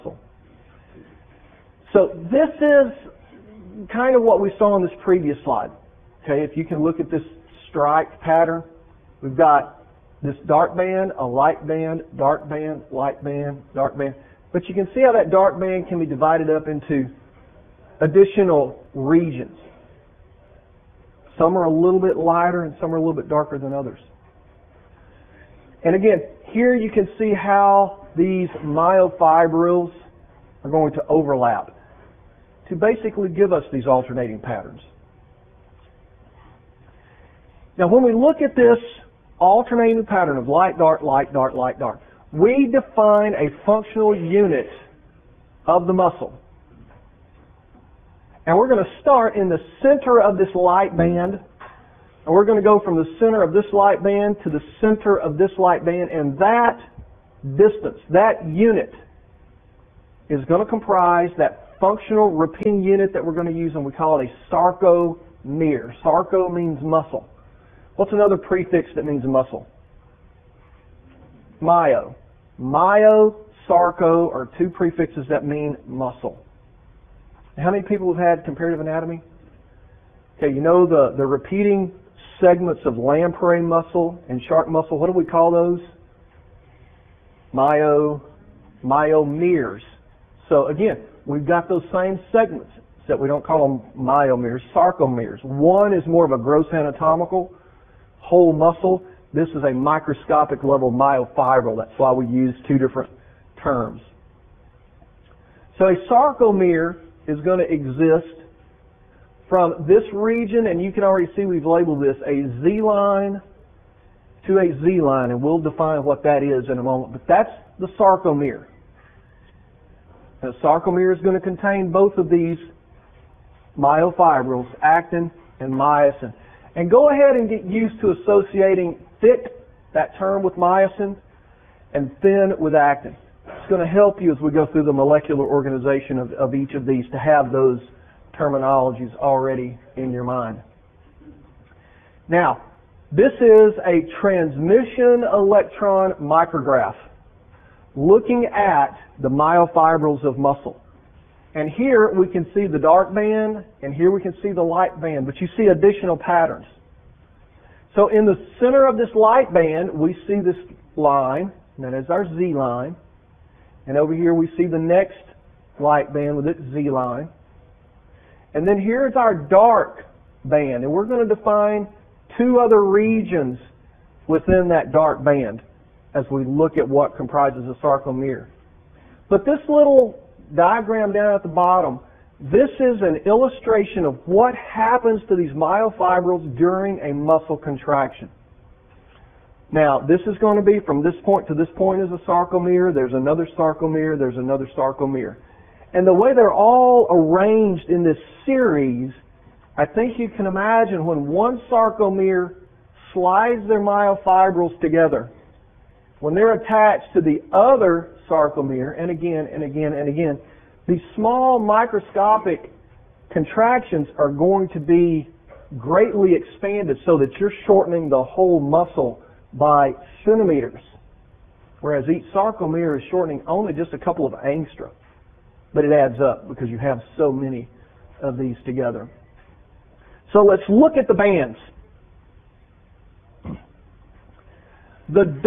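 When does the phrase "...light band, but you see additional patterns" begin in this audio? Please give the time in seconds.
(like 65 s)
154 s.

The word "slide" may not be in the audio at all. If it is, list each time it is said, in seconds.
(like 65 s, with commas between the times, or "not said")
5 s, 203 s.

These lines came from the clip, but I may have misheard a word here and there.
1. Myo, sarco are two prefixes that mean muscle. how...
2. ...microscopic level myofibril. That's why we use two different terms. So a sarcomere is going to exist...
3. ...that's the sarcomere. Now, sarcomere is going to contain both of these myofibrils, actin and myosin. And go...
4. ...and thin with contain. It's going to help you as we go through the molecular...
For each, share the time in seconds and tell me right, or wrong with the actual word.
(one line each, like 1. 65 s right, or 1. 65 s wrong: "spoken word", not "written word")
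1. 72 s right
2. 99 s right
3. 117 s right
4. 131 s wrong: "actin", not "contain".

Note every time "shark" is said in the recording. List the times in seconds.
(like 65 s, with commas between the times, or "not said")
84 s.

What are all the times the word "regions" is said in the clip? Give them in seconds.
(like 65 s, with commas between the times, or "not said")
18 s, 110 s, 172 s.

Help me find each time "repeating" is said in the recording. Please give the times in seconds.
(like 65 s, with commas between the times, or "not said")
62 s, 81 s.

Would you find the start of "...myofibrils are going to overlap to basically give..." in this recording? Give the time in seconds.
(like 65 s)
28 s.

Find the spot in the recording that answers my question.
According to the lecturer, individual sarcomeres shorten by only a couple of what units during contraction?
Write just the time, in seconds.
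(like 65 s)
224 s.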